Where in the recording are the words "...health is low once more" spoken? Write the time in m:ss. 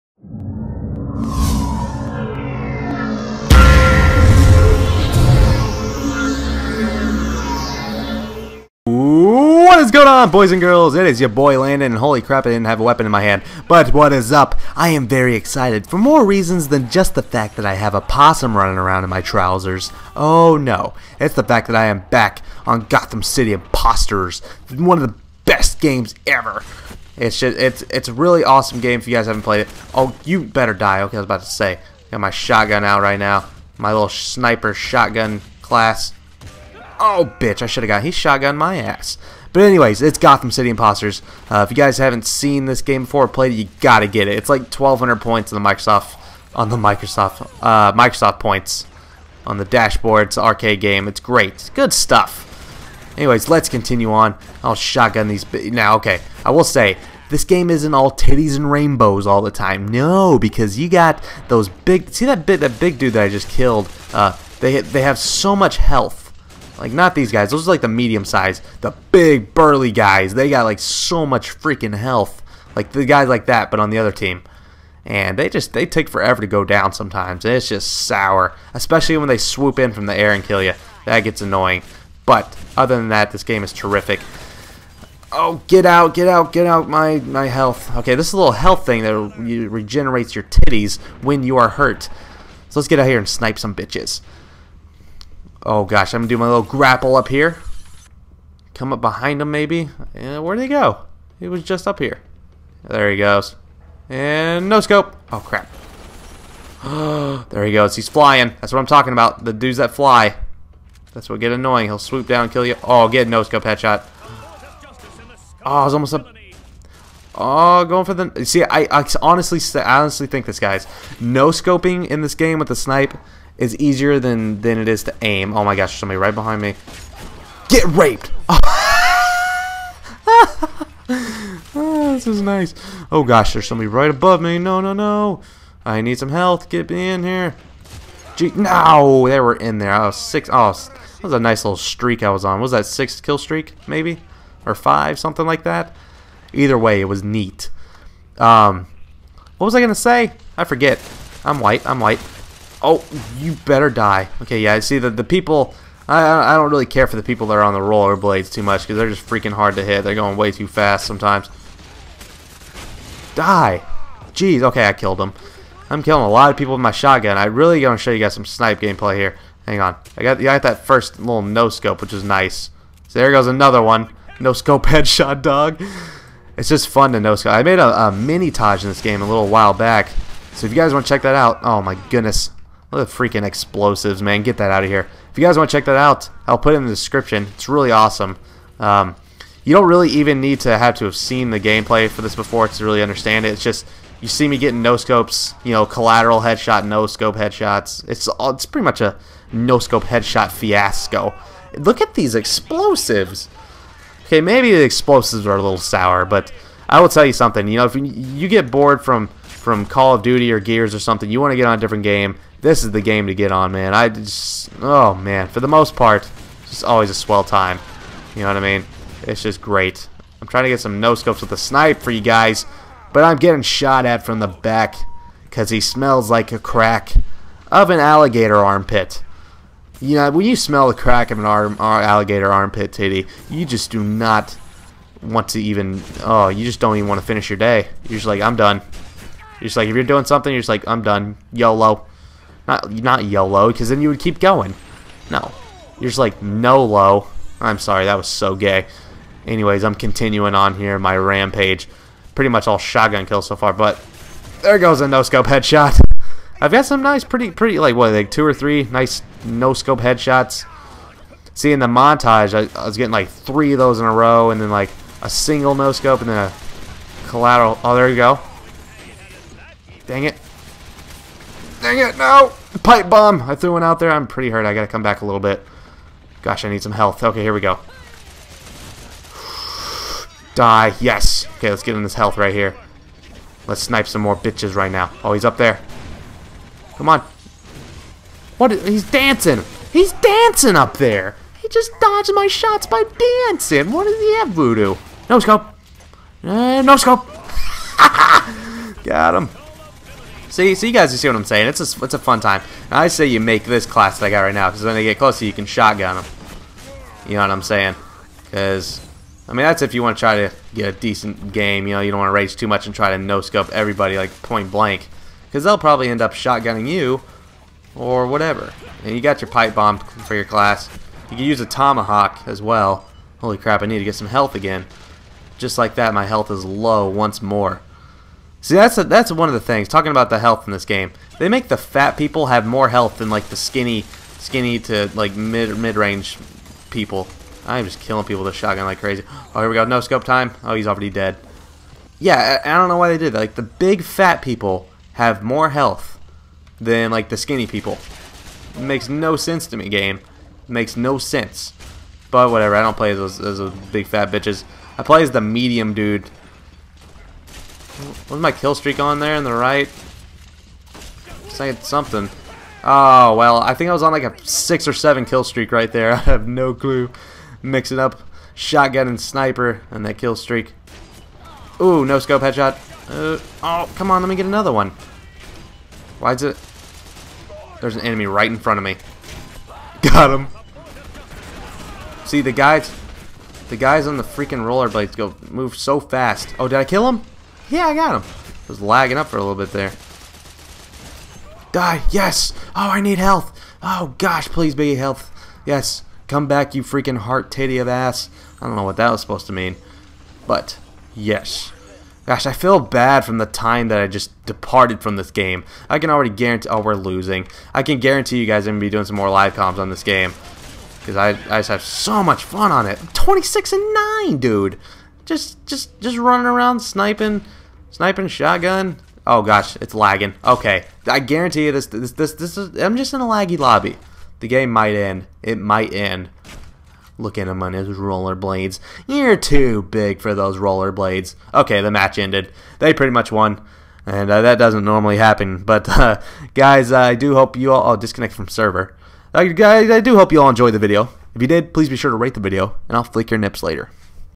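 5:26.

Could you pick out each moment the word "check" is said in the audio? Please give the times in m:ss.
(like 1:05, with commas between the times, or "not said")
3:01, 3:05.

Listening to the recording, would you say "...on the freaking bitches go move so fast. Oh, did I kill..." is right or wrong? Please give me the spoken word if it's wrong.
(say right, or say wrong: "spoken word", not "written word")
wrong: "rollerblades", not "bitches".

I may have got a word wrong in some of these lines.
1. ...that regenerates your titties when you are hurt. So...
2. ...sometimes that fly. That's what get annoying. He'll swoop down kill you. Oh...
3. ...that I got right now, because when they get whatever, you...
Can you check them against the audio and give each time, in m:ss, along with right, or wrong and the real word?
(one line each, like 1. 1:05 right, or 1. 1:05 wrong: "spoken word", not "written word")
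1. 1:29 right
2. 1:49 wrong: "dudes", not "sometimes"
3. 5:04 wrong: "closer", not "whatever".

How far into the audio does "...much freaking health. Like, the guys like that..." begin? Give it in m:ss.
1:11.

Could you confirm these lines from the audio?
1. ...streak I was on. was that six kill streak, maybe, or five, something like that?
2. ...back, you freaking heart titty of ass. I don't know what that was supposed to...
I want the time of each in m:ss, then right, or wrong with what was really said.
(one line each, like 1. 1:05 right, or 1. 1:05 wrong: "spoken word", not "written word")
1. 2:21 right
2. 6:36 right.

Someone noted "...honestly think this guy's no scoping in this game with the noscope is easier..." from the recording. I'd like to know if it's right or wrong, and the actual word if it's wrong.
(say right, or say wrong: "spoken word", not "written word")
wrong: "snipe", not "noscope".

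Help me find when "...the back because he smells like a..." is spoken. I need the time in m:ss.
3:44.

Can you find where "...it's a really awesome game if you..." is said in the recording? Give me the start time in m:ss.
0:27.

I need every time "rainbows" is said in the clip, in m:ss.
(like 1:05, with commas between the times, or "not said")
0:58.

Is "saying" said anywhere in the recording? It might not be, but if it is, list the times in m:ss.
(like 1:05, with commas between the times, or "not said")
5:01, 5:07, 6:01.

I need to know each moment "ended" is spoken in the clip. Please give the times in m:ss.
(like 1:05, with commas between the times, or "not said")
7:12.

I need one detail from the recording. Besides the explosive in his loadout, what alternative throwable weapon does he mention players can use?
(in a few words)
Tomahawk.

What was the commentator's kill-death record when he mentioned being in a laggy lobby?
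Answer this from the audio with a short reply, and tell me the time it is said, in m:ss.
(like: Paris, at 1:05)
26 and 9, at 6:53.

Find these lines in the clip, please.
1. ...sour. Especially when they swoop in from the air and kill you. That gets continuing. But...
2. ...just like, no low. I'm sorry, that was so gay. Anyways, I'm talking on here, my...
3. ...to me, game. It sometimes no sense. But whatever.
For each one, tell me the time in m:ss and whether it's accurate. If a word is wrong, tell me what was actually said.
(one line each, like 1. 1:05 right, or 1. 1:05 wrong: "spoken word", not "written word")
1. 1:18 wrong: "annoying", not "continuing"
2. 4:06 wrong: "continuing", not "talking"
3. 5:49 wrong: "makes", not "sometimes".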